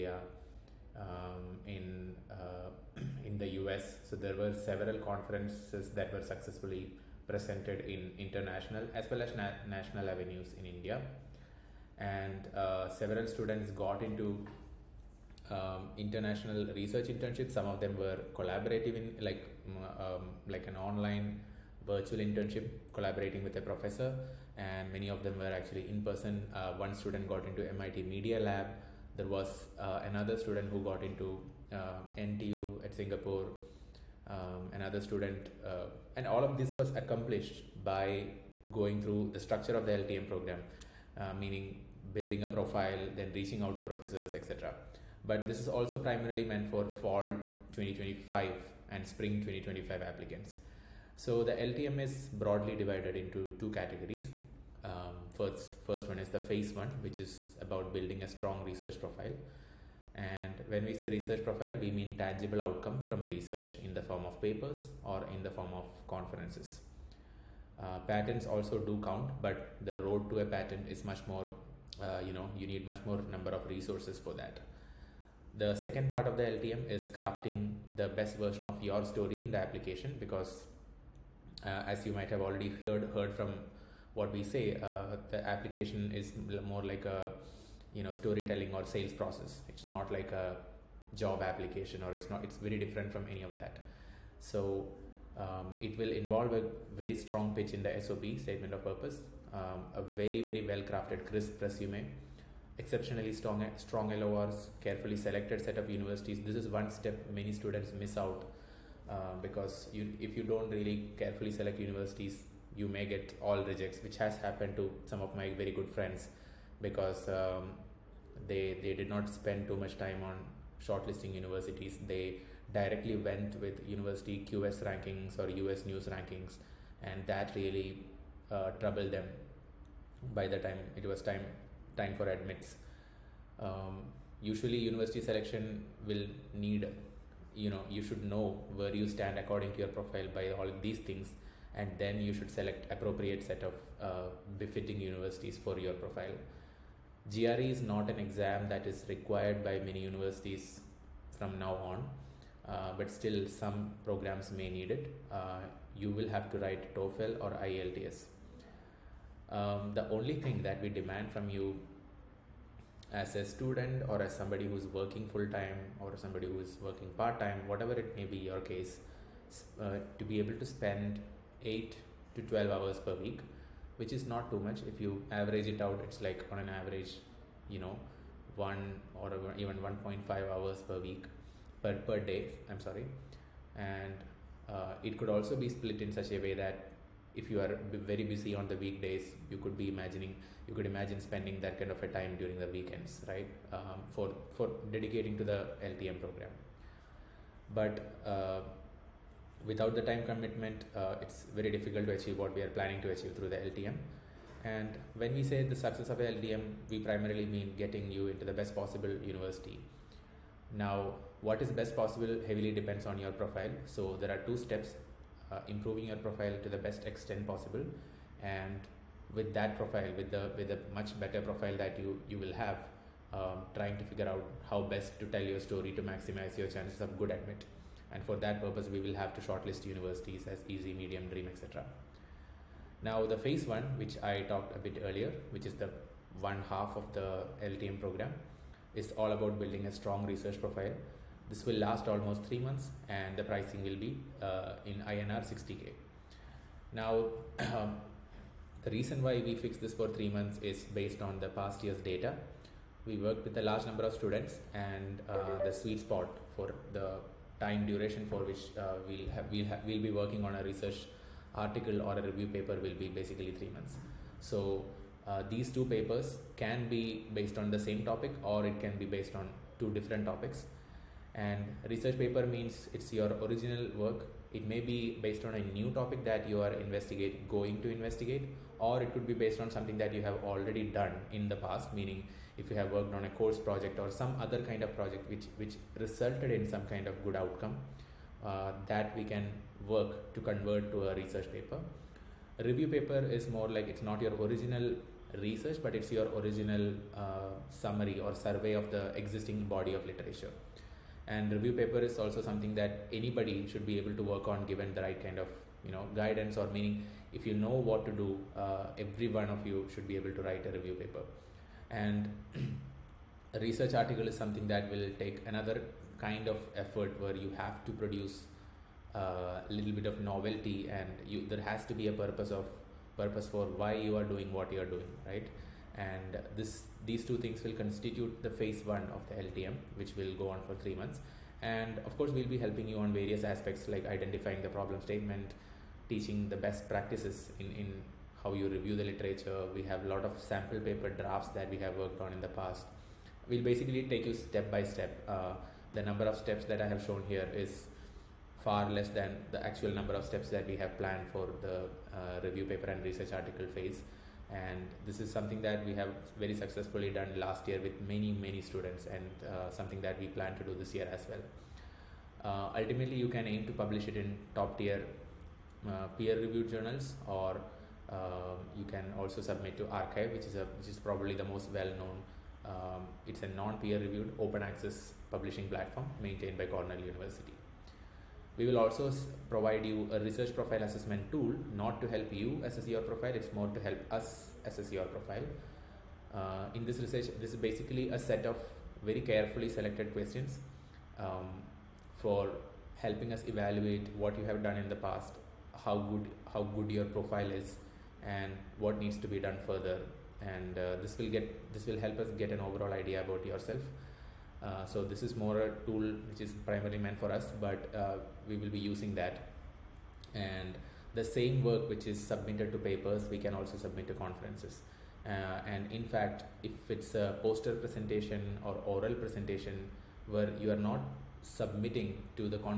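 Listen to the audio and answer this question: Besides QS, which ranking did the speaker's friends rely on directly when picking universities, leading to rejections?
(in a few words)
US News.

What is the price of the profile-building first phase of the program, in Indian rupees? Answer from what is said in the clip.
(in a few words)
INR 60k.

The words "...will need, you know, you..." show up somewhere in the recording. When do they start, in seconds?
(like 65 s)
136 s.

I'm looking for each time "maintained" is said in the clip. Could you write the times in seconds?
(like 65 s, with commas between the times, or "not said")
376 s.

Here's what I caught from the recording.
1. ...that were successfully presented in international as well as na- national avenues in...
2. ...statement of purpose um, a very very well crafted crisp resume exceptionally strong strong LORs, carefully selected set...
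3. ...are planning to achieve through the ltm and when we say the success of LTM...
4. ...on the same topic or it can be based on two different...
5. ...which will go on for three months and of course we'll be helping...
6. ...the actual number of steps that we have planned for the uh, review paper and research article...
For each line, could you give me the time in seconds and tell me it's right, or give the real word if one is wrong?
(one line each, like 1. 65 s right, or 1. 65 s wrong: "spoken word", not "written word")
1. 5 s right
2. 98 s right
3. 202 s right
4. 267 s right
5. 329 s right
6. 349 s right.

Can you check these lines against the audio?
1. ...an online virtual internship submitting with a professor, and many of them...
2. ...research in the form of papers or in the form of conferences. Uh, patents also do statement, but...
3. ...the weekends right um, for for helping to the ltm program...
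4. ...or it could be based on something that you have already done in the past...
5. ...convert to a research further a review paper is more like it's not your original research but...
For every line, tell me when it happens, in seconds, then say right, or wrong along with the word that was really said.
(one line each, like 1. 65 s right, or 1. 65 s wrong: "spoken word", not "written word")
1. 20 s wrong: "collaborating", not "submitting"
2. 63 s wrong: "count", not "statement"
3. 192 s wrong: "dedicating", not "helping"
4. 278 s right
5. 290 s wrong: "paper", not "further".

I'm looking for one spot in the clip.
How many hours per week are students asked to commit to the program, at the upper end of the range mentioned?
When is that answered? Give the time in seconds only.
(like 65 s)
171 s.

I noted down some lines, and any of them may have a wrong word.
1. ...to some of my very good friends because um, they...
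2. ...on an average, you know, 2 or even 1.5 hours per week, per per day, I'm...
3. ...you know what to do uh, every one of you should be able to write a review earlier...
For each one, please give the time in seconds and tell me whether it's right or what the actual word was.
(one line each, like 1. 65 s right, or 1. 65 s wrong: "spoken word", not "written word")
1. 114 s right
2. 176 s wrong: "1", not "2"
3. 307 s wrong: "paper", not "earlier".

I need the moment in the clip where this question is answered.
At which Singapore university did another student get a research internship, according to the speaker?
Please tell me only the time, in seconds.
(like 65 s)
32 s.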